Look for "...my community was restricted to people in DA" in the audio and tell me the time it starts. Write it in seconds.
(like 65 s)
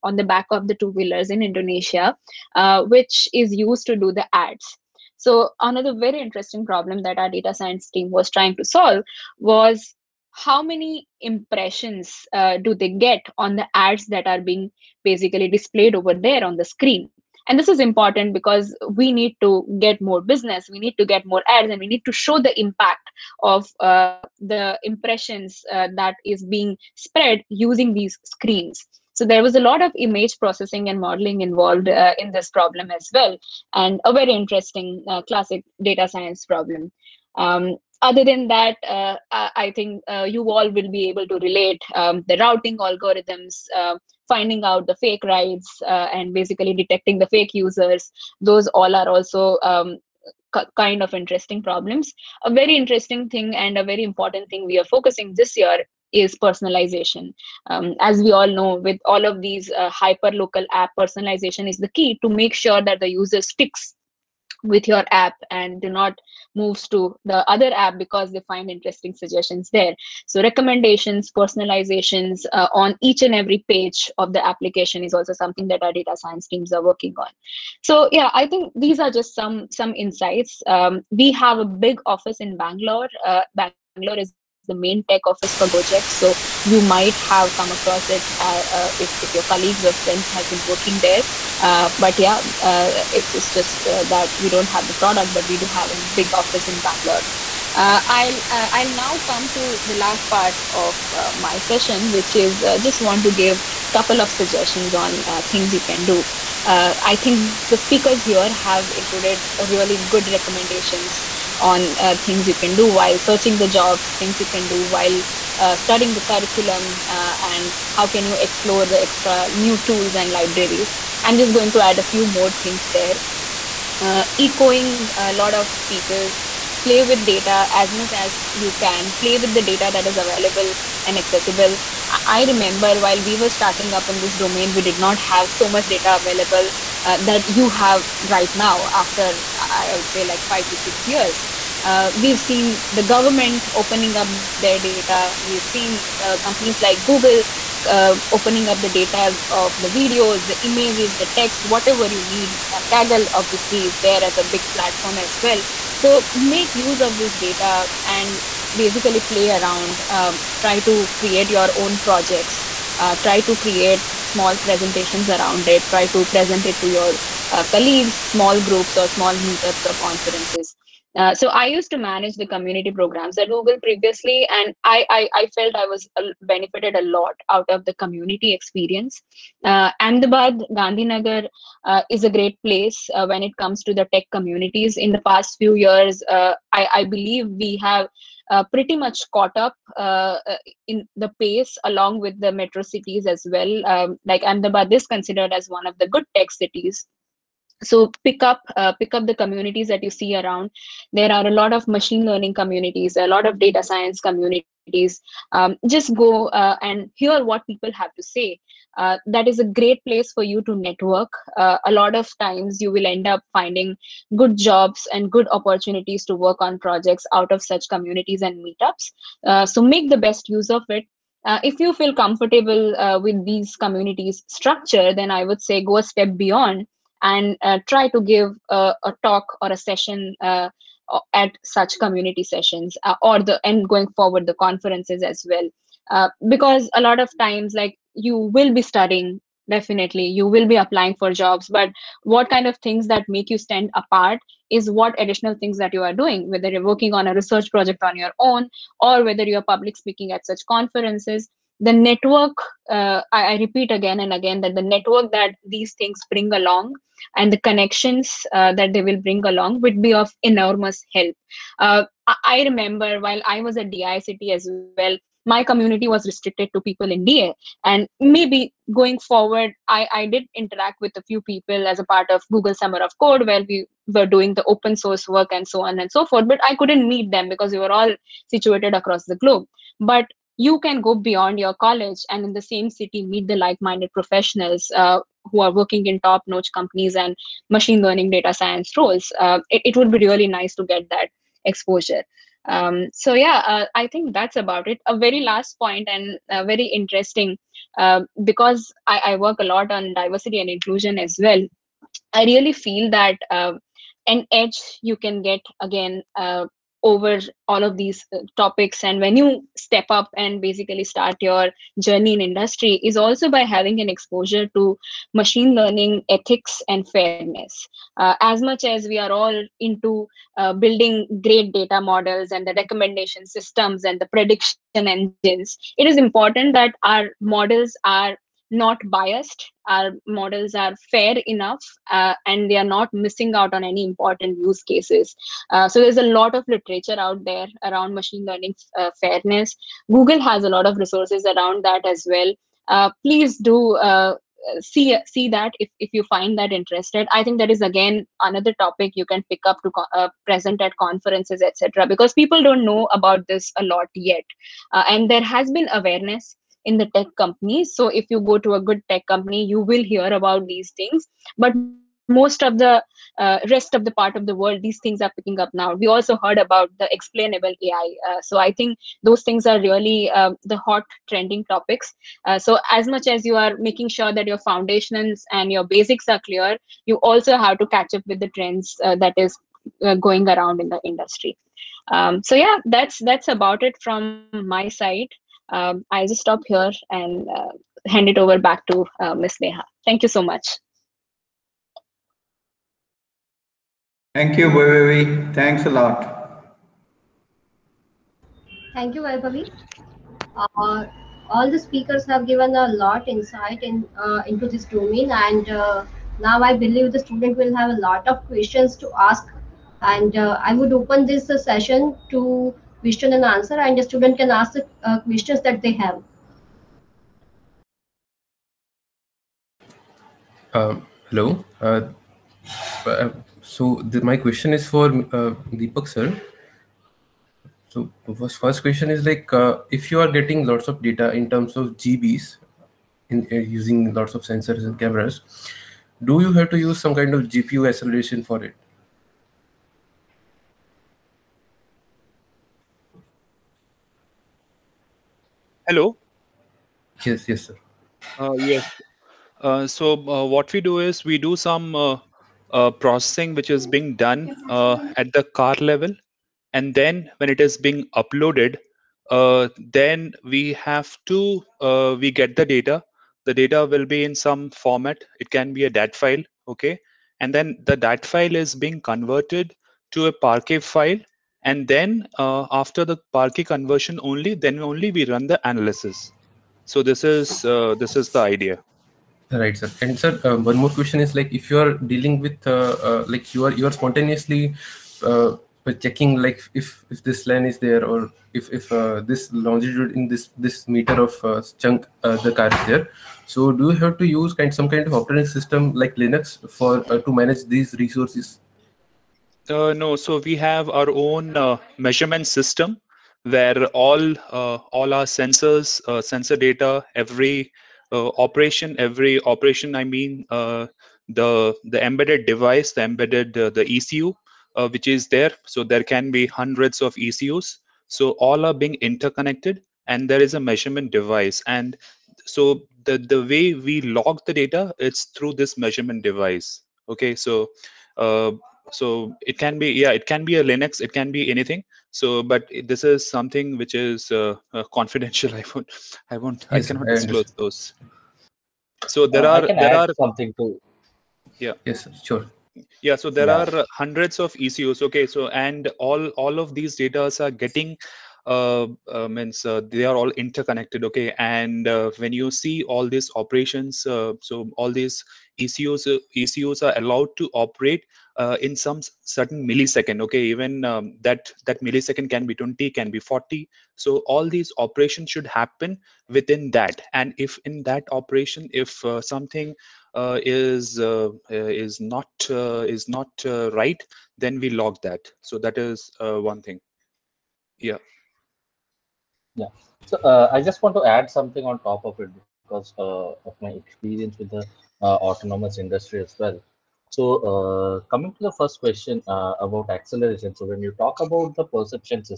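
265 s.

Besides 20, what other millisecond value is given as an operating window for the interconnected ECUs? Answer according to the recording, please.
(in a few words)
40.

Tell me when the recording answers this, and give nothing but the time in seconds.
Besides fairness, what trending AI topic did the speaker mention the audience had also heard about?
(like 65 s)
367 s.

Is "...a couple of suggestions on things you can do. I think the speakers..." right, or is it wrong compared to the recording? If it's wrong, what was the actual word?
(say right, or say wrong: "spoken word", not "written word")
right.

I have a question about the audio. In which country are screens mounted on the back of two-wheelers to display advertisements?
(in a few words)
Indonesia.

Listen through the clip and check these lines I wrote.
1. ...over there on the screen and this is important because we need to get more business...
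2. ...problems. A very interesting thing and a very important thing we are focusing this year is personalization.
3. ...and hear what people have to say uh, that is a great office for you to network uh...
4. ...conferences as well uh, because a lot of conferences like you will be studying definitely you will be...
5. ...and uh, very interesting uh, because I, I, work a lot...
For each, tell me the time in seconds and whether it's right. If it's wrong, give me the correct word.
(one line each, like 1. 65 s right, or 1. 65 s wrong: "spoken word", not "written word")
1. 15 s right
2. 51 s right
3. 206 s wrong: "place", not "office"
4. 234 s wrong: "times", not "conferences"
5. 296 s right.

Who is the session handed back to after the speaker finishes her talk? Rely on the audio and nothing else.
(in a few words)
Neha.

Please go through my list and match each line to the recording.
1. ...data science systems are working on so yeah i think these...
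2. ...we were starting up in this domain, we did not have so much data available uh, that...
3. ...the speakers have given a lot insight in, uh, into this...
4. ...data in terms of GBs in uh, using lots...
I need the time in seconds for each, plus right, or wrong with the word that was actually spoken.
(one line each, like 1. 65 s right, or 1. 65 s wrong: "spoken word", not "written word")
1. 75 s wrong: "teams", not "systems"
2. 133 s right
3. 401 s right
4. 431 s right.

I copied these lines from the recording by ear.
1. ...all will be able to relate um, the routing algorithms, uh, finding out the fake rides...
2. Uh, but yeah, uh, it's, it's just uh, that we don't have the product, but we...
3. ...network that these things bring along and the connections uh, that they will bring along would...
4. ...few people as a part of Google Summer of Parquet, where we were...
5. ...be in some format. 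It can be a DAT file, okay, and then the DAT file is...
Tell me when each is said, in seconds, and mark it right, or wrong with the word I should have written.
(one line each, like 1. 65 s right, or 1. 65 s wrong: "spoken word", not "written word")
1. 40 s right
2. 91 s right
3. 254 s right
4. 271 s wrong: "Code", not "Parquet"
5. 464 s right.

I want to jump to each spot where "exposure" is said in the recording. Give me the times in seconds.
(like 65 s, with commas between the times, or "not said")
291 s, 314 s.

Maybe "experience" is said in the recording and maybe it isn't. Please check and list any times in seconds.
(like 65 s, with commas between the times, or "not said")
178 s, 583 s.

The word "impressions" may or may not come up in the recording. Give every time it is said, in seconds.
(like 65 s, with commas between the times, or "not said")
11 s, 24 s.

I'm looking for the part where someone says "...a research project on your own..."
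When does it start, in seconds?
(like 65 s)
247 s.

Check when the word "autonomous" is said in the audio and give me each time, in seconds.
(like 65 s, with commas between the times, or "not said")
585 s.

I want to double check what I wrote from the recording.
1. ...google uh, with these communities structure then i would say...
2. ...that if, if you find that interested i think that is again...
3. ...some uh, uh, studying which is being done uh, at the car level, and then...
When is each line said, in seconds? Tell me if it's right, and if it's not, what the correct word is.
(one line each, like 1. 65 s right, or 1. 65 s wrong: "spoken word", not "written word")
1. 222 s wrong: "comfortable", not "google"
2. 345 s right
3. 451 s wrong: "processing", not "studying".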